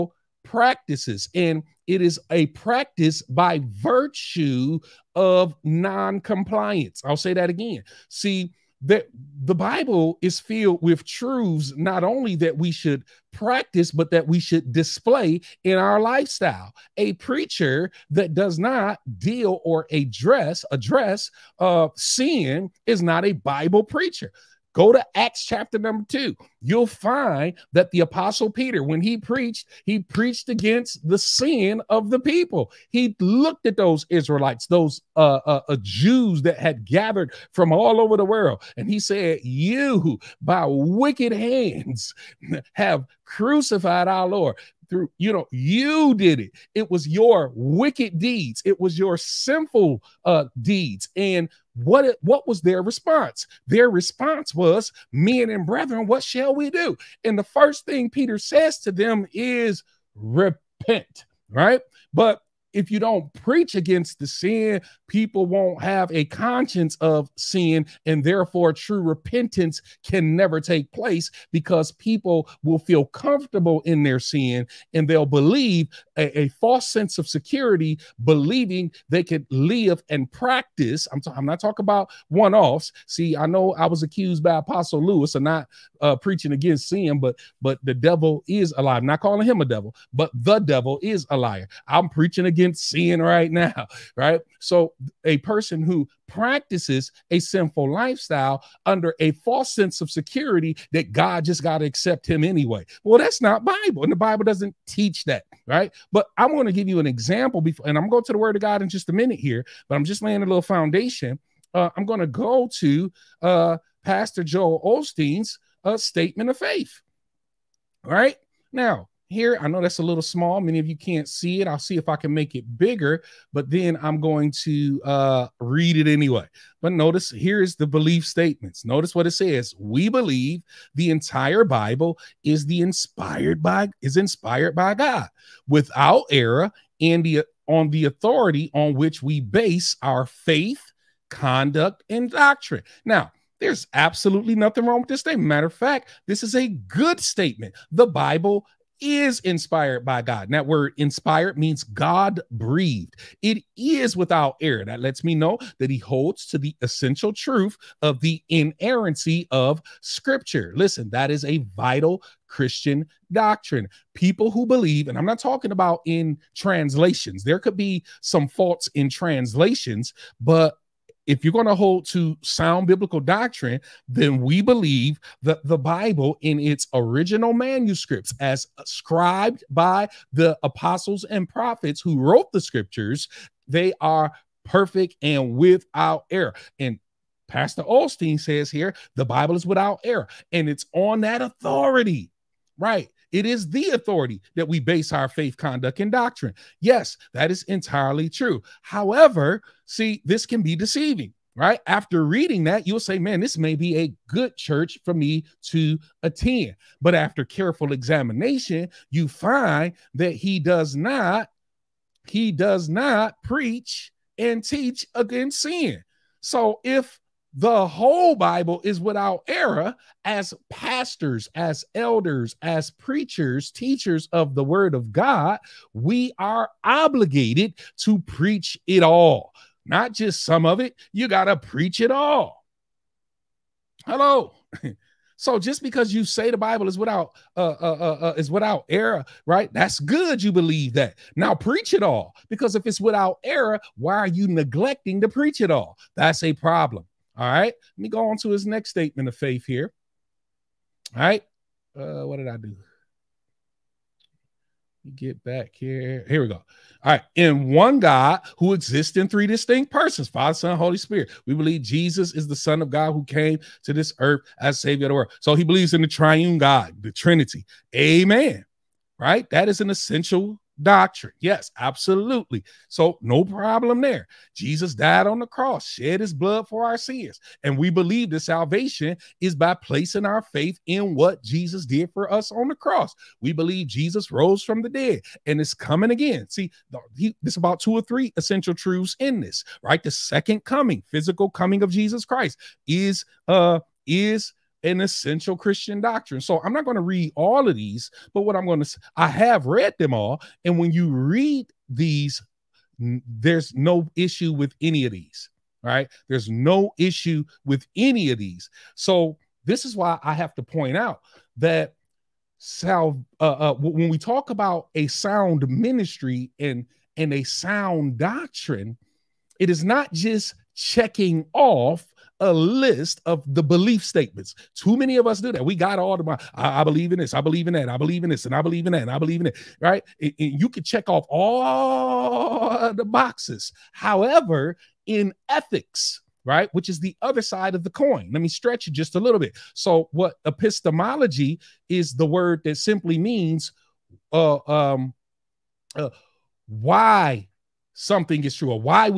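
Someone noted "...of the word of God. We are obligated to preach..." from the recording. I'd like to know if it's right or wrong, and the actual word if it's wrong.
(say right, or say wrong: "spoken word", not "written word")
right.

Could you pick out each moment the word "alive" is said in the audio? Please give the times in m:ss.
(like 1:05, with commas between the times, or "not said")
1:28.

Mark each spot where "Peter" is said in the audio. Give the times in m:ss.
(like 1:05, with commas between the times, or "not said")
0:28, 0:58.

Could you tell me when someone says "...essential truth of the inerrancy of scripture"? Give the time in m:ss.
2:36.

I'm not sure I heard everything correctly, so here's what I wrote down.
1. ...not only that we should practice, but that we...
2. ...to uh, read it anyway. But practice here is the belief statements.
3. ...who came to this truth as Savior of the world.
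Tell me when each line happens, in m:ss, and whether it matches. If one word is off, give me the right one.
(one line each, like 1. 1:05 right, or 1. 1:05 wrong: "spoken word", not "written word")
1. 0:11 right
2. 2:04 wrong: "notice", not "practice"
3. 4:23 wrong: "earth", not "truth".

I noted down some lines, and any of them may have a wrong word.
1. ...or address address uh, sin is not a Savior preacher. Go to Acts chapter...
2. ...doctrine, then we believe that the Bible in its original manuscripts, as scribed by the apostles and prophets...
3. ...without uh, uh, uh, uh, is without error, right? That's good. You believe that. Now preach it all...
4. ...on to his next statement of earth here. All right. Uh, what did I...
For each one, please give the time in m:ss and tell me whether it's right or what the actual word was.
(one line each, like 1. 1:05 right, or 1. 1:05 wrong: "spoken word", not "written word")
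1. 0:19 wrong: "Bible", not "Savior"
2. 2:53 right
3. 3:56 right
4. 4:08 wrong: "faith", not "earth".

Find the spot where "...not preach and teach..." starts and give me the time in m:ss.
3:32.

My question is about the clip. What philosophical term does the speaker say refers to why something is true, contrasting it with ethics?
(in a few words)
Epistemology.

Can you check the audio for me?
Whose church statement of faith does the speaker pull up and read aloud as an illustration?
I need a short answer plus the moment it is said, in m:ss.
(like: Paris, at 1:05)
Joel Osteen, at 1:54.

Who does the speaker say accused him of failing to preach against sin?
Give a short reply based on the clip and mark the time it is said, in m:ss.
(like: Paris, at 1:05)
Apostle Lewis, at 1:24.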